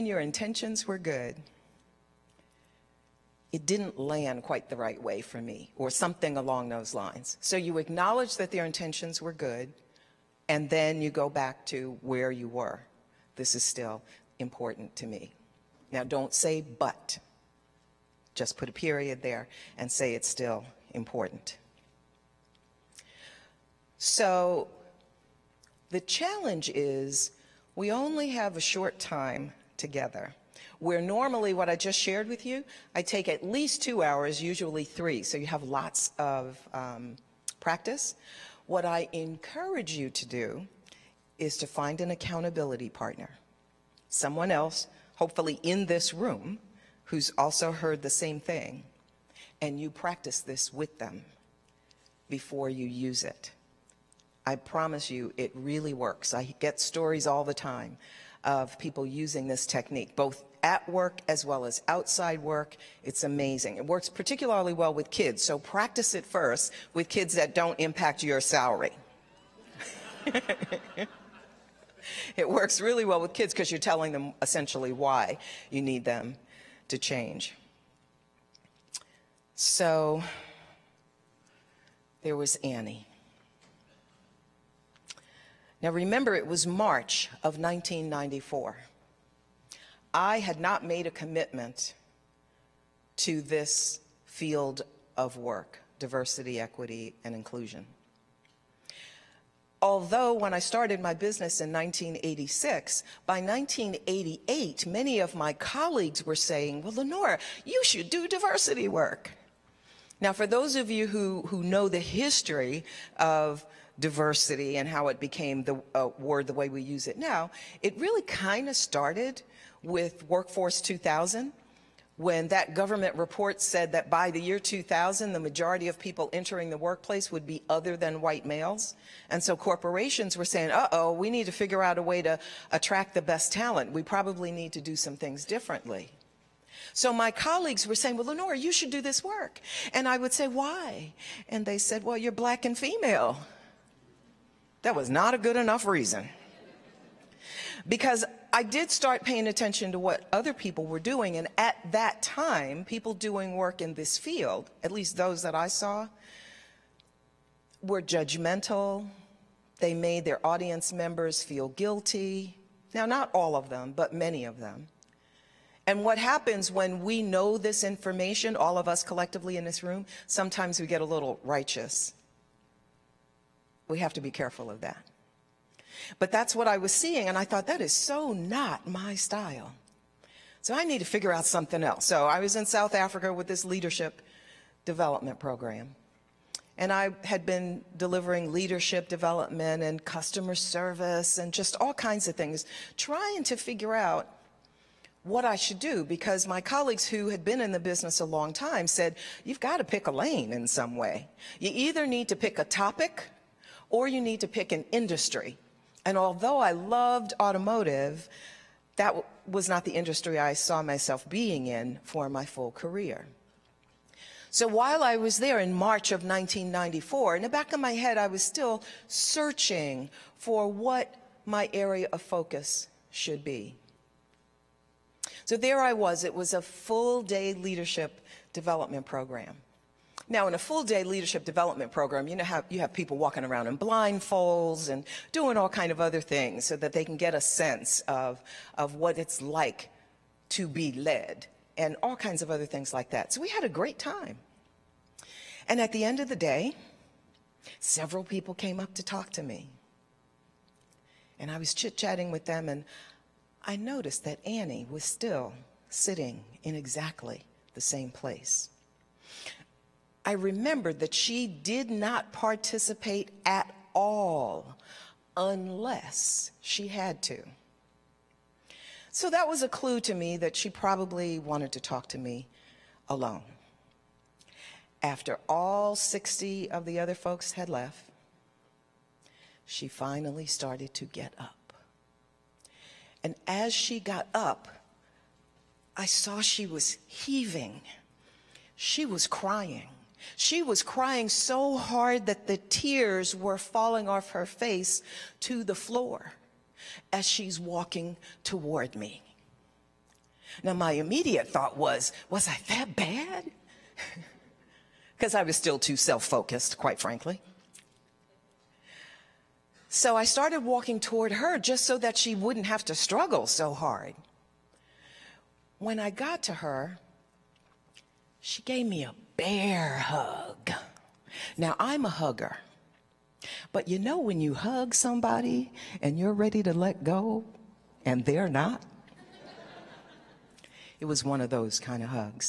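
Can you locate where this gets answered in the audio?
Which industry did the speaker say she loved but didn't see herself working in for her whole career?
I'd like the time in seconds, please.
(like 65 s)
207 s.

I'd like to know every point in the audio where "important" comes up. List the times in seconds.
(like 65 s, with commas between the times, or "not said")
14 s, 20 s.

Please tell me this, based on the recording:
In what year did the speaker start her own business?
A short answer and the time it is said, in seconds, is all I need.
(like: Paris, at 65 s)
1986, at 101 s.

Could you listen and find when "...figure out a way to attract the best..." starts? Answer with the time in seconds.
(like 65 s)
131 s.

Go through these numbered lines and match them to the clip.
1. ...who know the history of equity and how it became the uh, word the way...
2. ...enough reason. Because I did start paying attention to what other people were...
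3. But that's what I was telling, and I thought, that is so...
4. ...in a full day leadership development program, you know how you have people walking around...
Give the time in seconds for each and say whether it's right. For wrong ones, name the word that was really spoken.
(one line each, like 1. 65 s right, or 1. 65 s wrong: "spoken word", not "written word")
1. 111 s wrong: "diversity", not "equity"
2. 145 s right
3. 176 s wrong: "seeing", not "telling"
4. 230 s right.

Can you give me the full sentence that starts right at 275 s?
After all 60 of the other folks had left, she finally started to get up.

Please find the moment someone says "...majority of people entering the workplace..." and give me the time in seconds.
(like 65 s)
125 s.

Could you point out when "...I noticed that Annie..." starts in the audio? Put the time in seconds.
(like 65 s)
253 s.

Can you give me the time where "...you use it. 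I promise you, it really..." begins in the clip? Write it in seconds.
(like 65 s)
52 s.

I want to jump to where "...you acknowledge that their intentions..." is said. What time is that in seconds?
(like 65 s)
7 s.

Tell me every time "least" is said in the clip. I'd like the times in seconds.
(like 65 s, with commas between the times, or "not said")
33 s, 154 s.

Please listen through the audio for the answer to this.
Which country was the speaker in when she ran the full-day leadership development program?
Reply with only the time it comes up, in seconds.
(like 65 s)
182 s.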